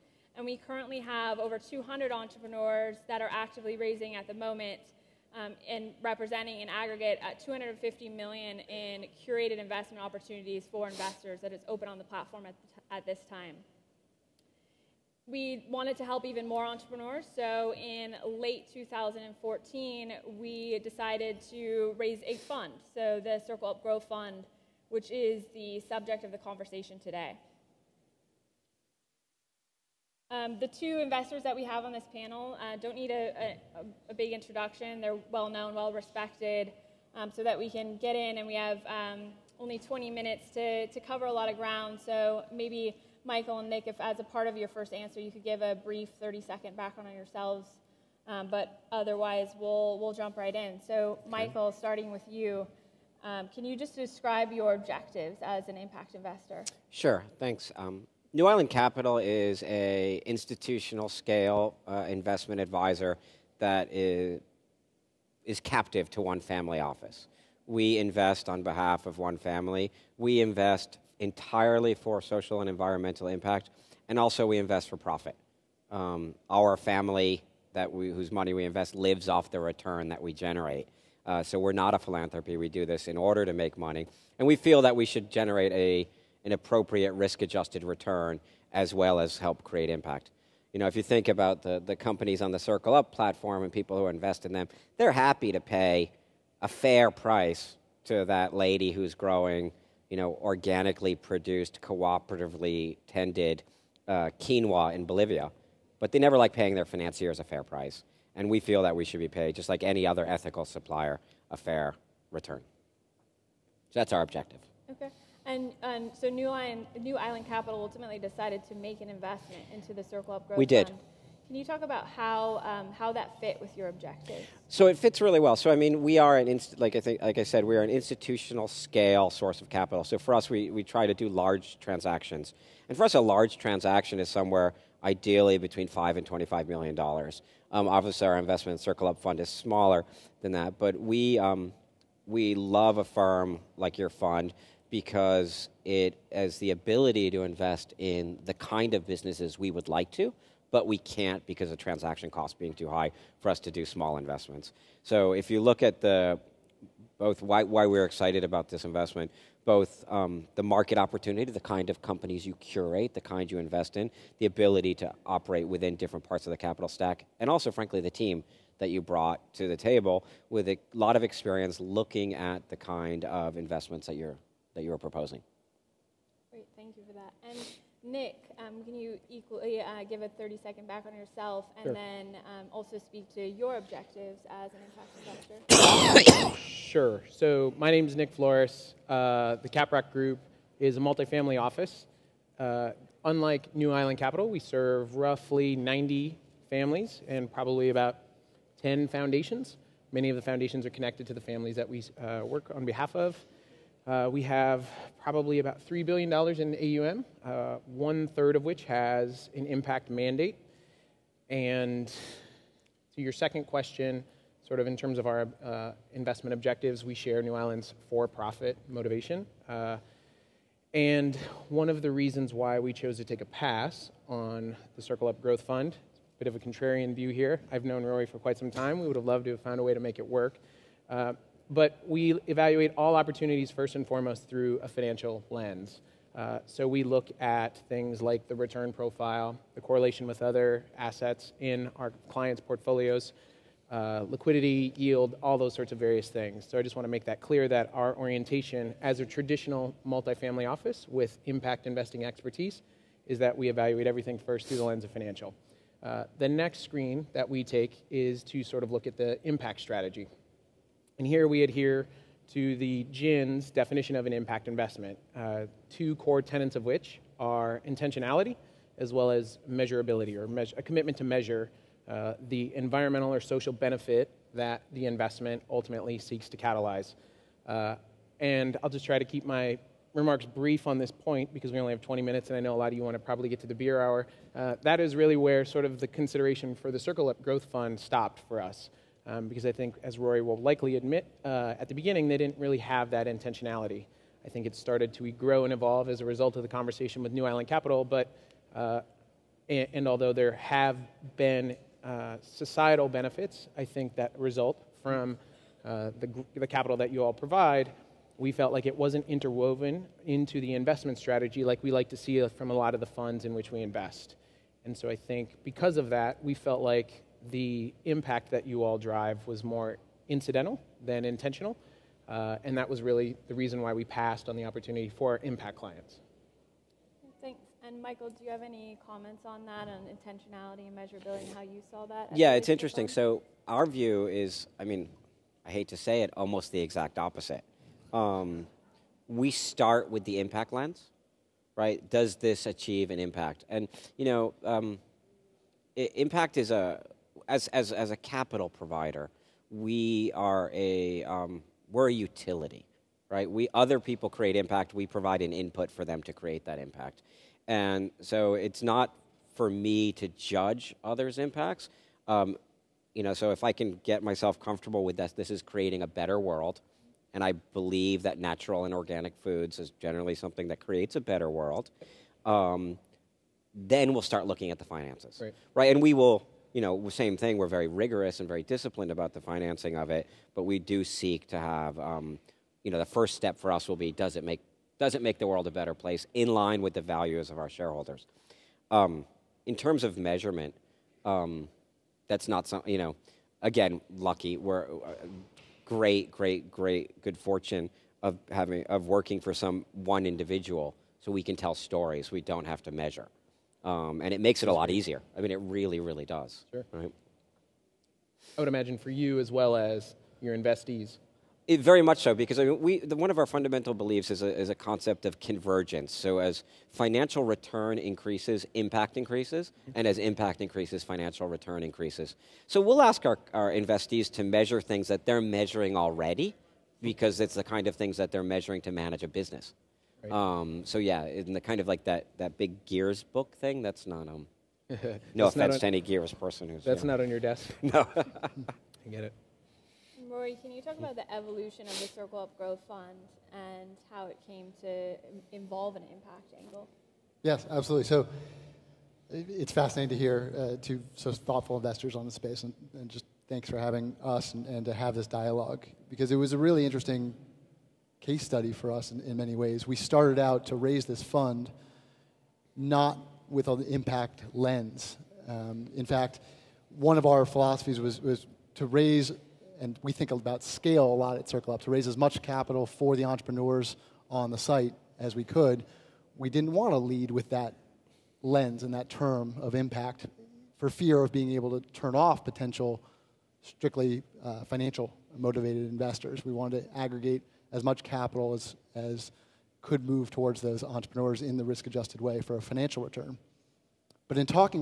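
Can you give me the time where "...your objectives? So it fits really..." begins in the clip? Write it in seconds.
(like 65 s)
123 s.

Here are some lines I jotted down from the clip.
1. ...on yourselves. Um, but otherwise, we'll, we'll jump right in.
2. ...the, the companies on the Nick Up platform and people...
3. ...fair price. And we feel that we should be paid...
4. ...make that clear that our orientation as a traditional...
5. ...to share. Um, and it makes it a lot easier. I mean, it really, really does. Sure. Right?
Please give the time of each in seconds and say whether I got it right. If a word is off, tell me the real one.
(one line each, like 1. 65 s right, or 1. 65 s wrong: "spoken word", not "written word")
1. 47 s right
2. 91 s wrong: "Circle", not "Nick"
3. 107 s right
4. 247 s right
5. 402 s wrong: "measure", not "share".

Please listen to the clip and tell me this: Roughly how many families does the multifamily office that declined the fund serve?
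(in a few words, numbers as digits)
90.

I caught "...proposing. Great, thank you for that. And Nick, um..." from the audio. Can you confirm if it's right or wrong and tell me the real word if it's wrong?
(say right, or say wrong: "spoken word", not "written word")
right.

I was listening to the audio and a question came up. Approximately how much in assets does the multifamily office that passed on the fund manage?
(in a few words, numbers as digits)
$3 billion.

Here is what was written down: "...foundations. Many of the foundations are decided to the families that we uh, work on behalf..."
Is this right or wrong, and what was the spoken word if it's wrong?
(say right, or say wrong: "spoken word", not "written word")
wrong: "connected", not "decided".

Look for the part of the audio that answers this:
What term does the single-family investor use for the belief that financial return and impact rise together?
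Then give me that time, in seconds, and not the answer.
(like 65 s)
415 s.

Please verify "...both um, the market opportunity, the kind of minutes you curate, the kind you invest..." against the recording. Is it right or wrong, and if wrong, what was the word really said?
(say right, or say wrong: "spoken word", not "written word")
wrong: "companies", not "minutes".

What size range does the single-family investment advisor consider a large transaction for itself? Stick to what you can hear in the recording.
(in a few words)
$5 to $25 million.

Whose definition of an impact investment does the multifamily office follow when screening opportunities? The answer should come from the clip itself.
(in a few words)
The GIIN.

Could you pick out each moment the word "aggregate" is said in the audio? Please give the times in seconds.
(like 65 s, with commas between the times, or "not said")
6 s, 486 s.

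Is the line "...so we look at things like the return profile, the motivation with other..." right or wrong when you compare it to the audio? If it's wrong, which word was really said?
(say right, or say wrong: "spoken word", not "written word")
wrong: "correlation", not "motivation".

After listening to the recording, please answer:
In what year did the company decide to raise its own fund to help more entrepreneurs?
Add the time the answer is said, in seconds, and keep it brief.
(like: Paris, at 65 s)
2014, at 18 s.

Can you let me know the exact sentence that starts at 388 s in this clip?
Um, in terms of measurement, um, that's not something you know.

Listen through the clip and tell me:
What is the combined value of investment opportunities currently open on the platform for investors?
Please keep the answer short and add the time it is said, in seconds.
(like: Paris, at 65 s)
$250 million, at 7 s.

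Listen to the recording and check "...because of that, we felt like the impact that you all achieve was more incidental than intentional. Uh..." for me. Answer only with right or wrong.
wrong.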